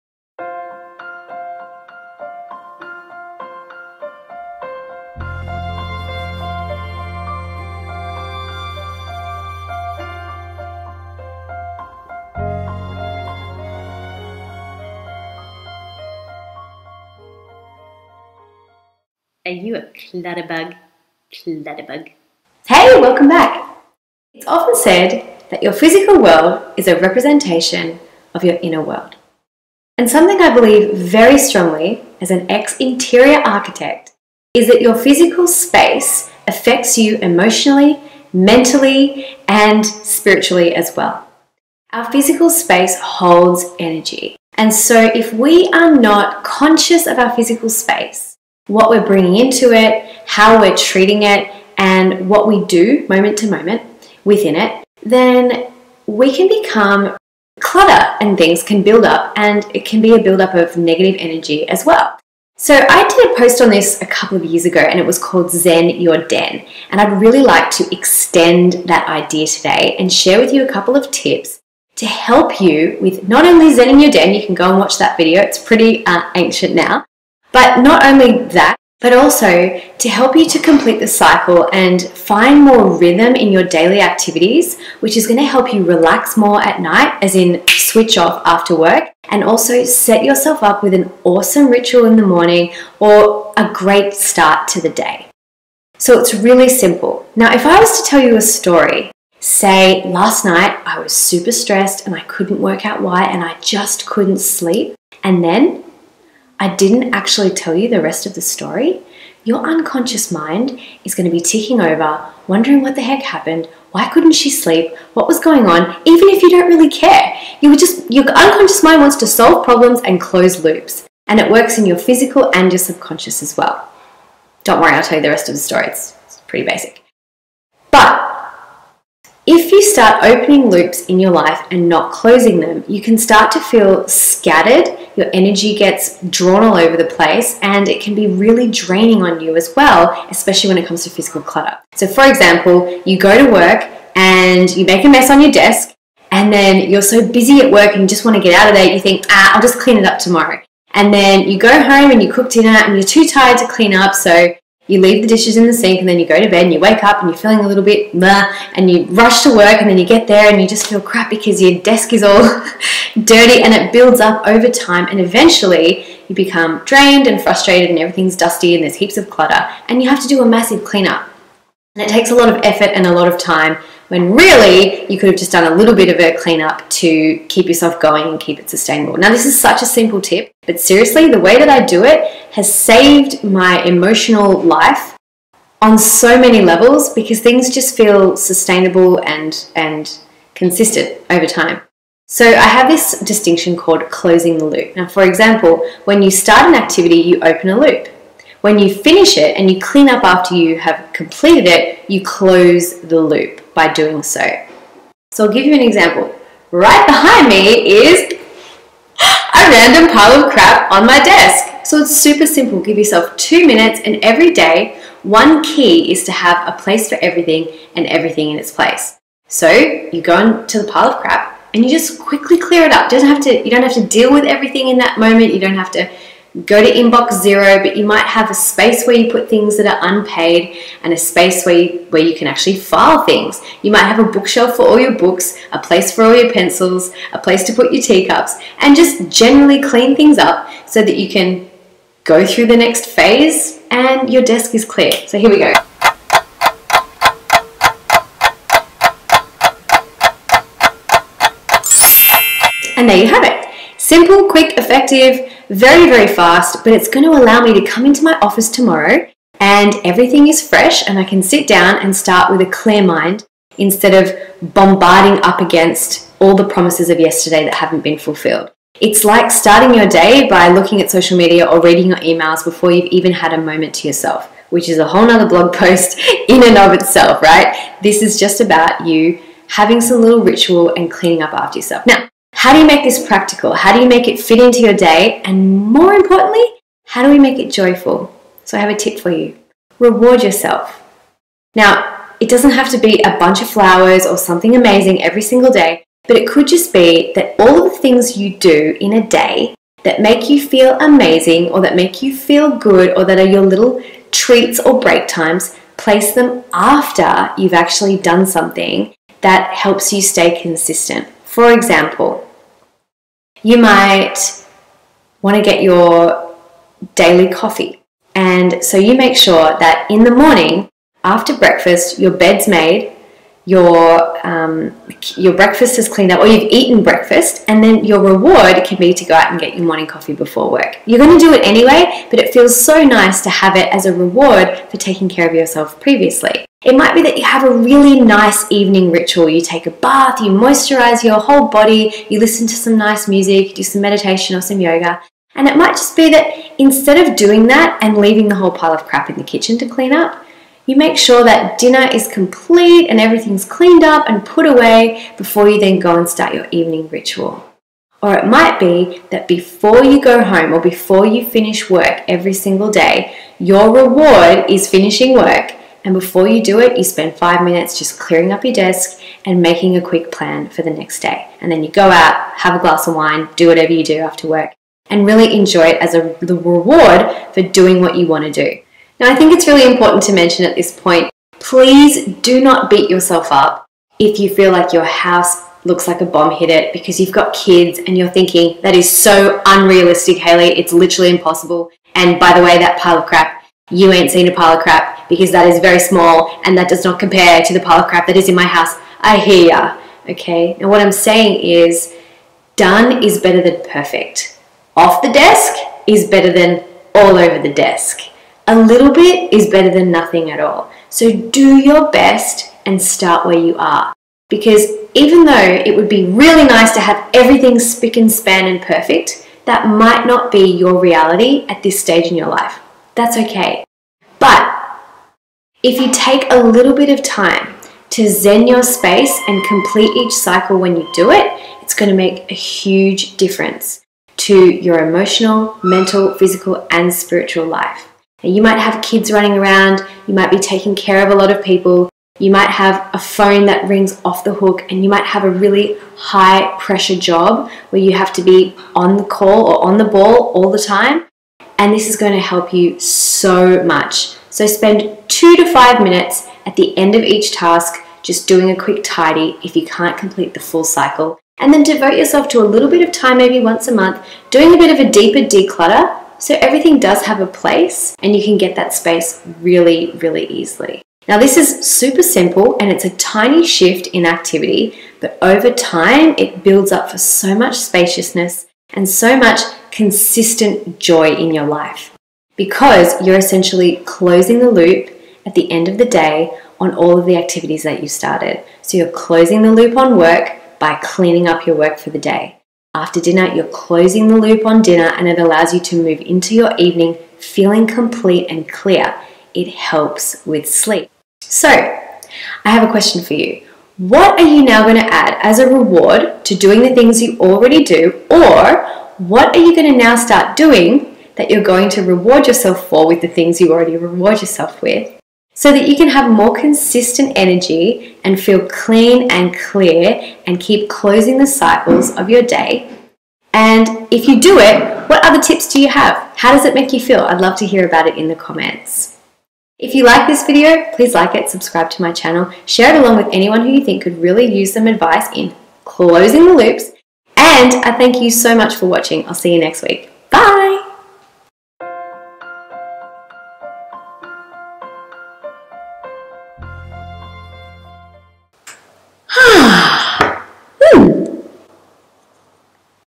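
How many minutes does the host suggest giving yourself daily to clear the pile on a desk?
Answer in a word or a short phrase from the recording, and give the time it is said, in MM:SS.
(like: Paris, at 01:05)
2, at 03:33.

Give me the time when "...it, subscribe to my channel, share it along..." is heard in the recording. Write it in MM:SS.
08:51.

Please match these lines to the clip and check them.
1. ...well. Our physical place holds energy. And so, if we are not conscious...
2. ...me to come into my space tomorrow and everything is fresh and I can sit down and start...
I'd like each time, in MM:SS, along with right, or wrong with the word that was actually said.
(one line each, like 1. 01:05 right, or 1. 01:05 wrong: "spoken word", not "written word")
1. 00:40 wrong: "space", not "place"
2. 04:17 wrong: "office", not "space".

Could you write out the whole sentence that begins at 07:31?
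And this is going to help you so much.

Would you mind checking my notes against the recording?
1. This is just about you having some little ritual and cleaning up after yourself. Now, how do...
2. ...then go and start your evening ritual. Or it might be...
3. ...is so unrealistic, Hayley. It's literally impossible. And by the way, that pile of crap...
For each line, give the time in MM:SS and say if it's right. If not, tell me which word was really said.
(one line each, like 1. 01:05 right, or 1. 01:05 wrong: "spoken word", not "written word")
1. 04:38 right
2. 05:55 right
3. 06:28 right.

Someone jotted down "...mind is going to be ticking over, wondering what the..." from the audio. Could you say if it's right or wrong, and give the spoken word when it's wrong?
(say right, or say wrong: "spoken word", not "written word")
right.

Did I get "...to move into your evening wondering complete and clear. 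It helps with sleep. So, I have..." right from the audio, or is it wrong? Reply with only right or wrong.
wrong.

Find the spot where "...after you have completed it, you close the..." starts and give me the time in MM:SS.
03:20.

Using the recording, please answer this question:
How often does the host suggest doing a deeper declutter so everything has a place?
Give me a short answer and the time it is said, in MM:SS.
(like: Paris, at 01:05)
Once a month, at 07:43.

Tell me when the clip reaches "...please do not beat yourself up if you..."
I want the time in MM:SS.
06:21.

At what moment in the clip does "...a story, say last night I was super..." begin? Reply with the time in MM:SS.
01:38.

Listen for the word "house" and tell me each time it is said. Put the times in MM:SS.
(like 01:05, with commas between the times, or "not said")
06:25, 06:38.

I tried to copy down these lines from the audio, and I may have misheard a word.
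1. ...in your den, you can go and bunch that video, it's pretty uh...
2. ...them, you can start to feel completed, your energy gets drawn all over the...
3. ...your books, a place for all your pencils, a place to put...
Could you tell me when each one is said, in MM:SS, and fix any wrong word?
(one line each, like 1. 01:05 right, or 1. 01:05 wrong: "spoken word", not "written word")
1. 01:13 wrong: "watch", not "bunch"
2. 02:12 wrong: "scattered", not "completed"
3. 03:54 right.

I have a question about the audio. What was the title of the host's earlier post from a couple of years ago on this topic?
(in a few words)
Zen Your Den.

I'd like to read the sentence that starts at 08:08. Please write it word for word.
So you're closing the loop on work by cleaning up your work for the day.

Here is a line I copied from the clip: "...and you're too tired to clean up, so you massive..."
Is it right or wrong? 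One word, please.
wrong.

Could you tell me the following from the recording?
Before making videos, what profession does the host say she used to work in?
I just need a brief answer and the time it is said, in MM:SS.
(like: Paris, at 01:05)
Interior architect, at 00:32.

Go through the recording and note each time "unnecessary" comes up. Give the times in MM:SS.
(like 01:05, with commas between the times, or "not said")
not said.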